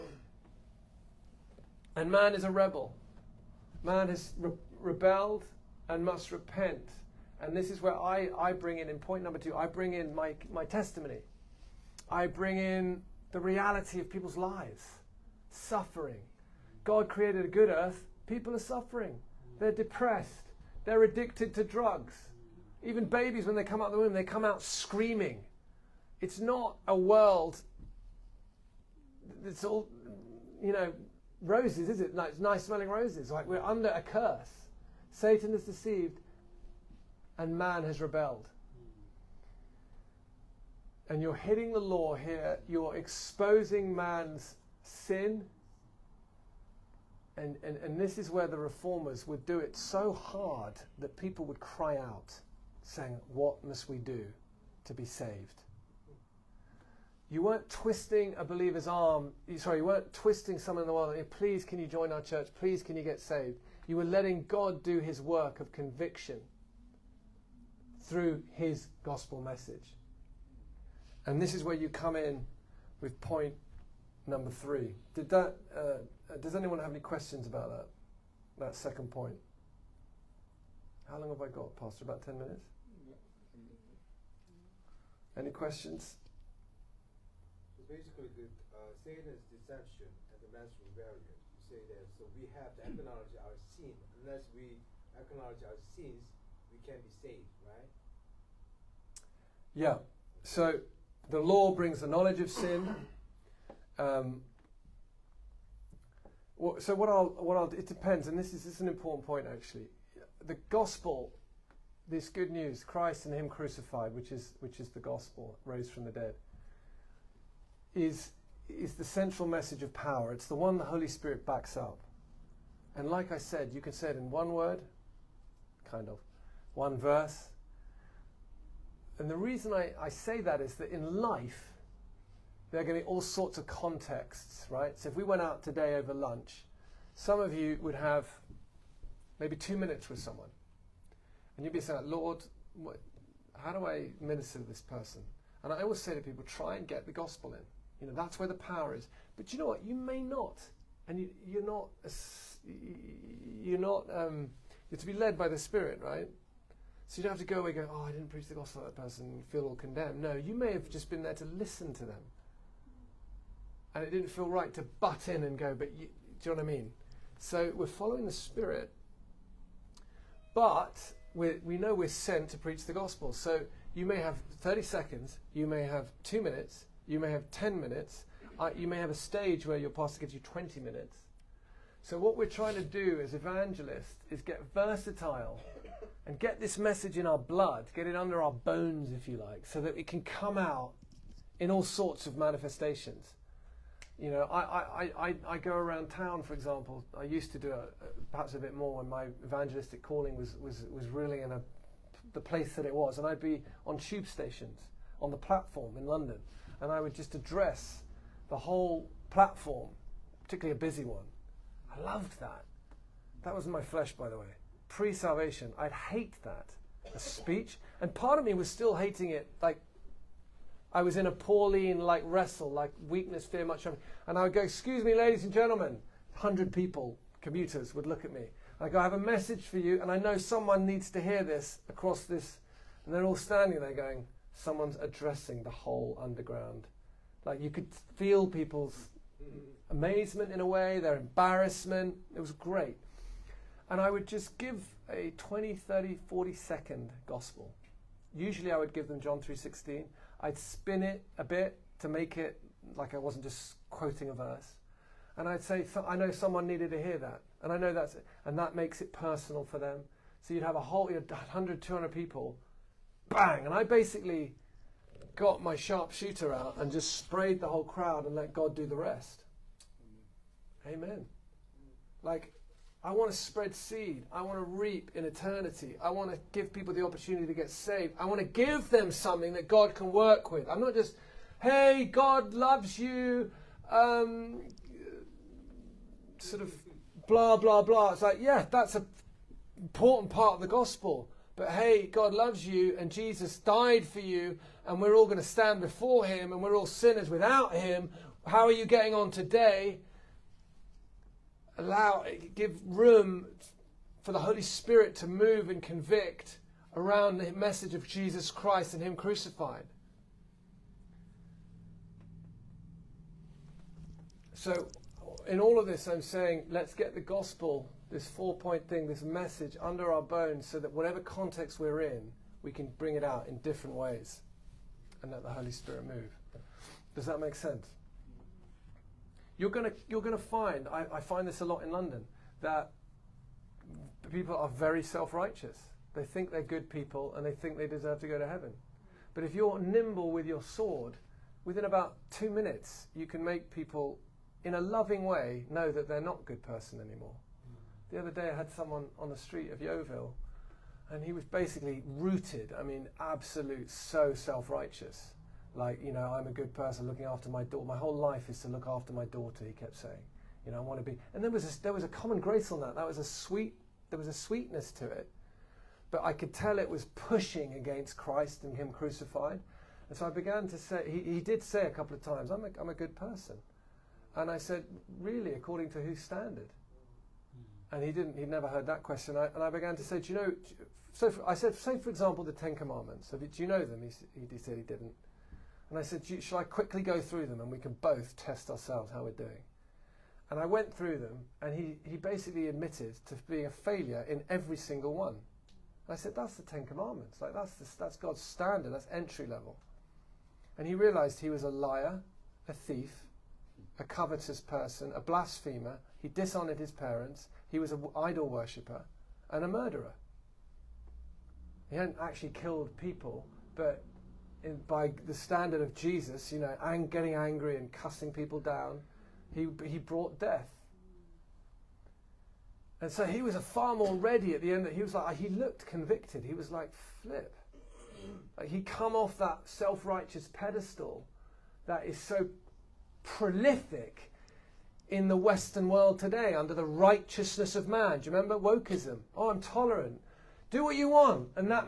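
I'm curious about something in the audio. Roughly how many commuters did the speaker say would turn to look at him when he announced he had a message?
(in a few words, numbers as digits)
100.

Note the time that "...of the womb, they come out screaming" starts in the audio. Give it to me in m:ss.
0:23.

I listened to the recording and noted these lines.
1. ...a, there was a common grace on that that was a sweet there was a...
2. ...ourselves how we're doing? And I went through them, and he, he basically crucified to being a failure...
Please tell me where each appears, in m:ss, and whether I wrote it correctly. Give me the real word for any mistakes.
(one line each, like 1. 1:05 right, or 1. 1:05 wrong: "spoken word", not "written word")
1. 6:01 right
2. 6:28 wrong: "admitted", not "crucified".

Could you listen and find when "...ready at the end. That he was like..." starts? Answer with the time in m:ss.
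7:04.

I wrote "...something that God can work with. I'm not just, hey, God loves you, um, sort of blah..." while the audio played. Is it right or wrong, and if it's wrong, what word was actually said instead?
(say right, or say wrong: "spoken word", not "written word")
right.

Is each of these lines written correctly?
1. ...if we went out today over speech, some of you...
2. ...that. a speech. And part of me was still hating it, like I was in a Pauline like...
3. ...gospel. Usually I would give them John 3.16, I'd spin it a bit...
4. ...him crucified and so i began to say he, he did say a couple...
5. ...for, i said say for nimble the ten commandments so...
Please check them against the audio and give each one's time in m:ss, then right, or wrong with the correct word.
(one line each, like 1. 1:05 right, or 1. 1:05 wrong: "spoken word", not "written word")
1. 2:15 wrong: "lunch", not "speech"
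2. 3:36 right
3. 4:07 right
4. 6:08 right
5. 6:21 wrong: "example", not "nimble".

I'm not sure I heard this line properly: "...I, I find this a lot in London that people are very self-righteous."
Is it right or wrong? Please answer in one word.
right.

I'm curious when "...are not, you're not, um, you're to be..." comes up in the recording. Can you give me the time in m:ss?
2:31.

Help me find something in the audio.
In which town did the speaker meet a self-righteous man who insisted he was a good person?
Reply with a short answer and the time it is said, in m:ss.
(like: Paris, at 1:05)
Yeovil, at 5:49.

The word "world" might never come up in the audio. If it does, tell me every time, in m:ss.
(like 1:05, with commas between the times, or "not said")
0:26, 1:00, 7:15.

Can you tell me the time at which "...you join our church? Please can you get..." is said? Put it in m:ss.
1:01.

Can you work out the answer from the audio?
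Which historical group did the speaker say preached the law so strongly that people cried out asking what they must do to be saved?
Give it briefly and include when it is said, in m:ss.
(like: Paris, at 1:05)
The reformers, at 0:48.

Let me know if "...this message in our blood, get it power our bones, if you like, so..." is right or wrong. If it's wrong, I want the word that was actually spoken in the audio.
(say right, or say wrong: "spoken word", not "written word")
wrong: "under", not "power".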